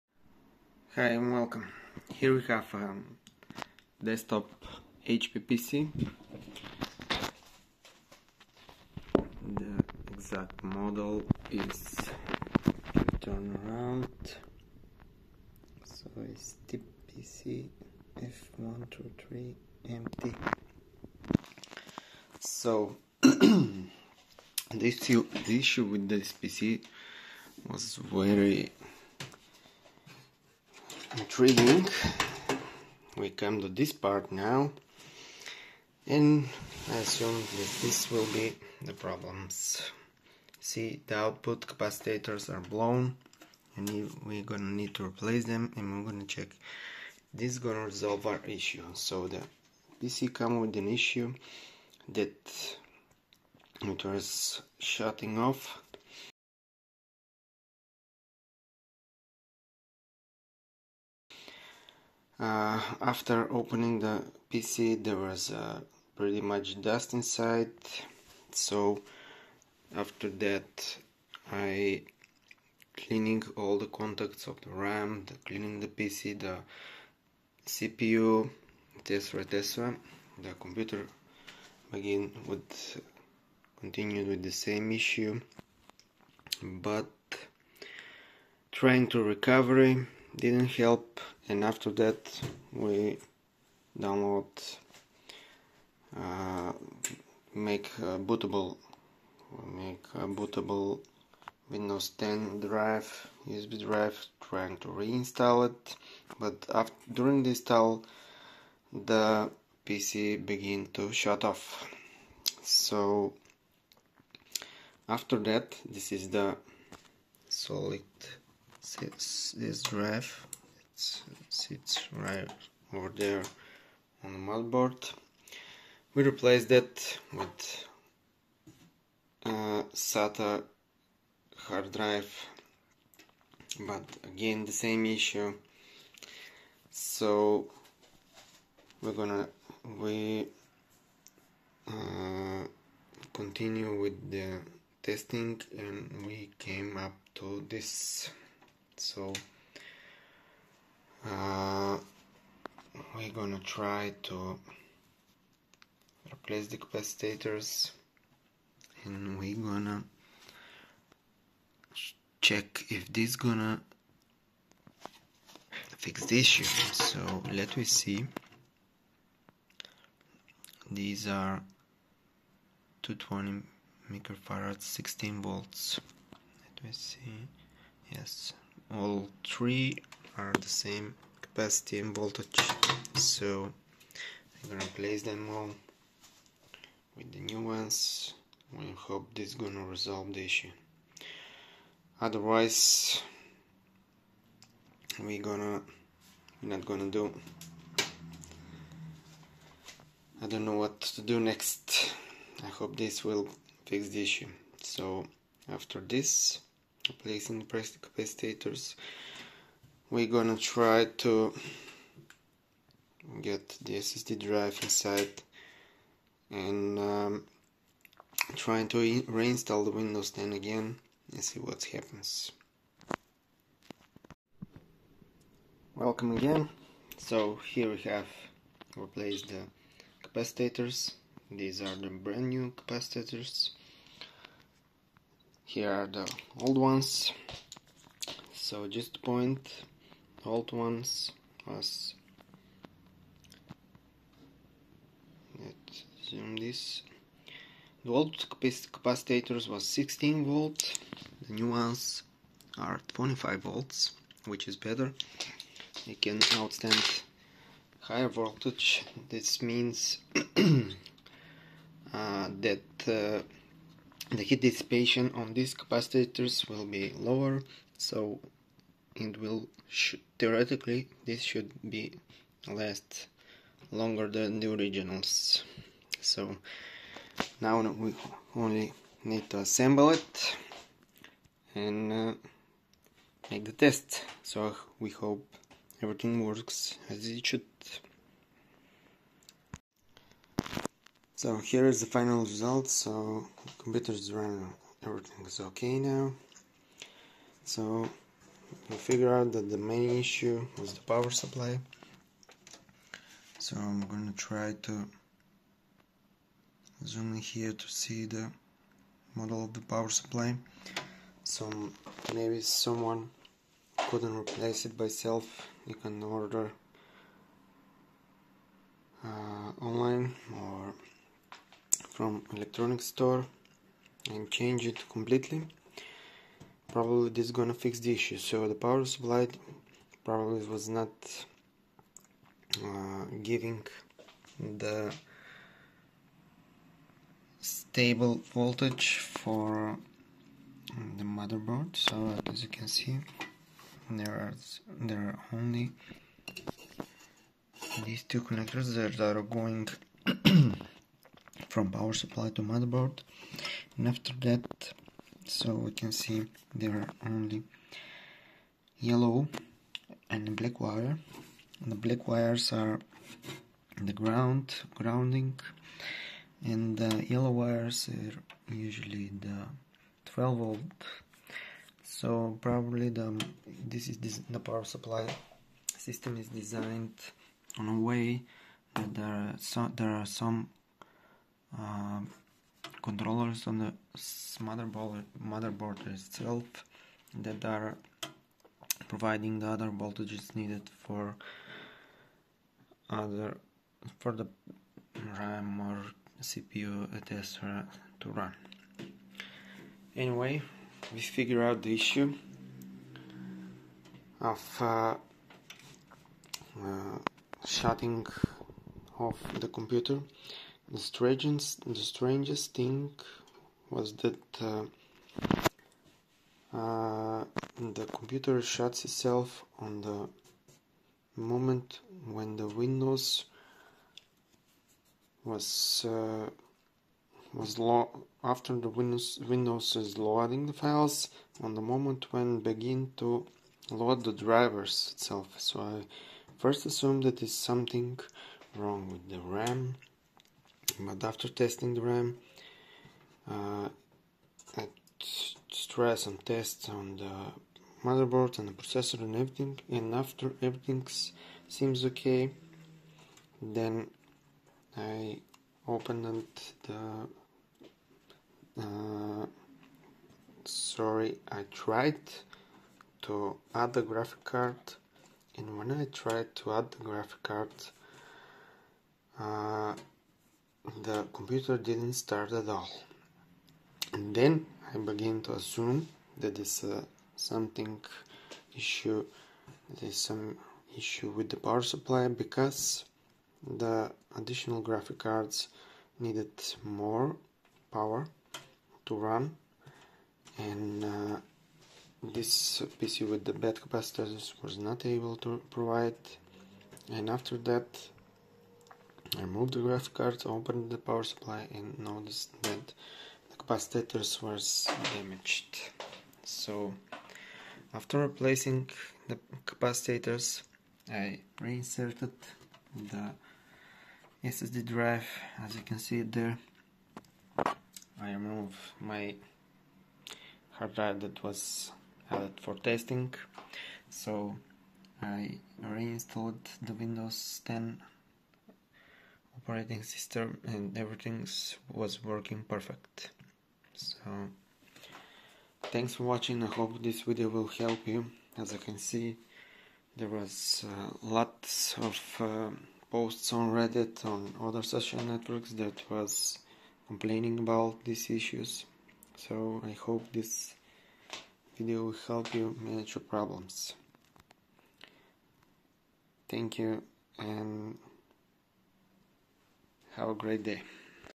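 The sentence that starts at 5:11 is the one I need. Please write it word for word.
So maybe someone couldn't replace it by self.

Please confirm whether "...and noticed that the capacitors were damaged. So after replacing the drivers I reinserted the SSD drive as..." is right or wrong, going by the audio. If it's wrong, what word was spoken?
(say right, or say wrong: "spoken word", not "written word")
wrong: "capacitors", not "drivers".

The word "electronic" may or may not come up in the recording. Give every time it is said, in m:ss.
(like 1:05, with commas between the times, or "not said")
5:22.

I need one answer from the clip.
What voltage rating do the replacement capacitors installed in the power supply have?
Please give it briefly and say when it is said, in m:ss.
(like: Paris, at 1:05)
25 volts, at 4:13.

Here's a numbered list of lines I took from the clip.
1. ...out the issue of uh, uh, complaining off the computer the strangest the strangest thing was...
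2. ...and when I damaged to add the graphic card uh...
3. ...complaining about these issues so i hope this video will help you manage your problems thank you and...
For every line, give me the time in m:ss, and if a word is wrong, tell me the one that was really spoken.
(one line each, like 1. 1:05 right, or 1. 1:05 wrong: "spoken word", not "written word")
1. 6:41 wrong: "shutting", not "complaining"
2. 7:45 wrong: "tried", not "damaged"
3. 9:07 right.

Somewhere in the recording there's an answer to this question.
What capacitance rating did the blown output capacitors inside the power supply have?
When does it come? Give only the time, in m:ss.
2:53.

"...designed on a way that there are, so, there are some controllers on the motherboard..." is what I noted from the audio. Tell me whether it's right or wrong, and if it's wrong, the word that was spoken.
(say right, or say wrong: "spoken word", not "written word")
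right.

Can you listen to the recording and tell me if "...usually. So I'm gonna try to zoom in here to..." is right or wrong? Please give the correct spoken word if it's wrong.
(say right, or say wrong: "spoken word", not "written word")
wrong: "supply", not "usually".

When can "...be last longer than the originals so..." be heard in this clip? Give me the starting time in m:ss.
4:31.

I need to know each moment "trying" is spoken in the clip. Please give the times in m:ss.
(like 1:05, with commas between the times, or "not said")
1:28, 1:44, 3:38.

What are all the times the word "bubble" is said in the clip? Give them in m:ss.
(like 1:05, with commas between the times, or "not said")
not said.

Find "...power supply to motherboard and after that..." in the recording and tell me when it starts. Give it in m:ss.
5:51.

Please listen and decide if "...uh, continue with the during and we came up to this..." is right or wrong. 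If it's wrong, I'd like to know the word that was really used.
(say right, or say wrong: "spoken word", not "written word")
wrong: "testing", not "during".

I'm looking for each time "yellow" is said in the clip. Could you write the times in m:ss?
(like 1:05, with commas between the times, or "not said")
5:58, 6:07.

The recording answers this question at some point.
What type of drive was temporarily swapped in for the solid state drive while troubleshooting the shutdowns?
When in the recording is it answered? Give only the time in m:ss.
2:09.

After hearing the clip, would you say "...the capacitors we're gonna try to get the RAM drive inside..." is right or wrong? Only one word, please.
wrong.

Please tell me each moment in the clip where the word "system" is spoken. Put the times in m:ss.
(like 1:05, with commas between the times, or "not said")
6:15, 8:50.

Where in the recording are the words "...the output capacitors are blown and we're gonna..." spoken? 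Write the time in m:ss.
0:41.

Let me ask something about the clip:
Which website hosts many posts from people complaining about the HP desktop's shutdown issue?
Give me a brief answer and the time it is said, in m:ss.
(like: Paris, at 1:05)
Reddit, at 9:03.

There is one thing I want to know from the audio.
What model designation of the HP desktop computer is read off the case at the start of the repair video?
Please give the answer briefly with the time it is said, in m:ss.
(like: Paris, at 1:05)
TPC F123 MT, at 0:16.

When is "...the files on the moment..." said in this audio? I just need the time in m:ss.
7:10.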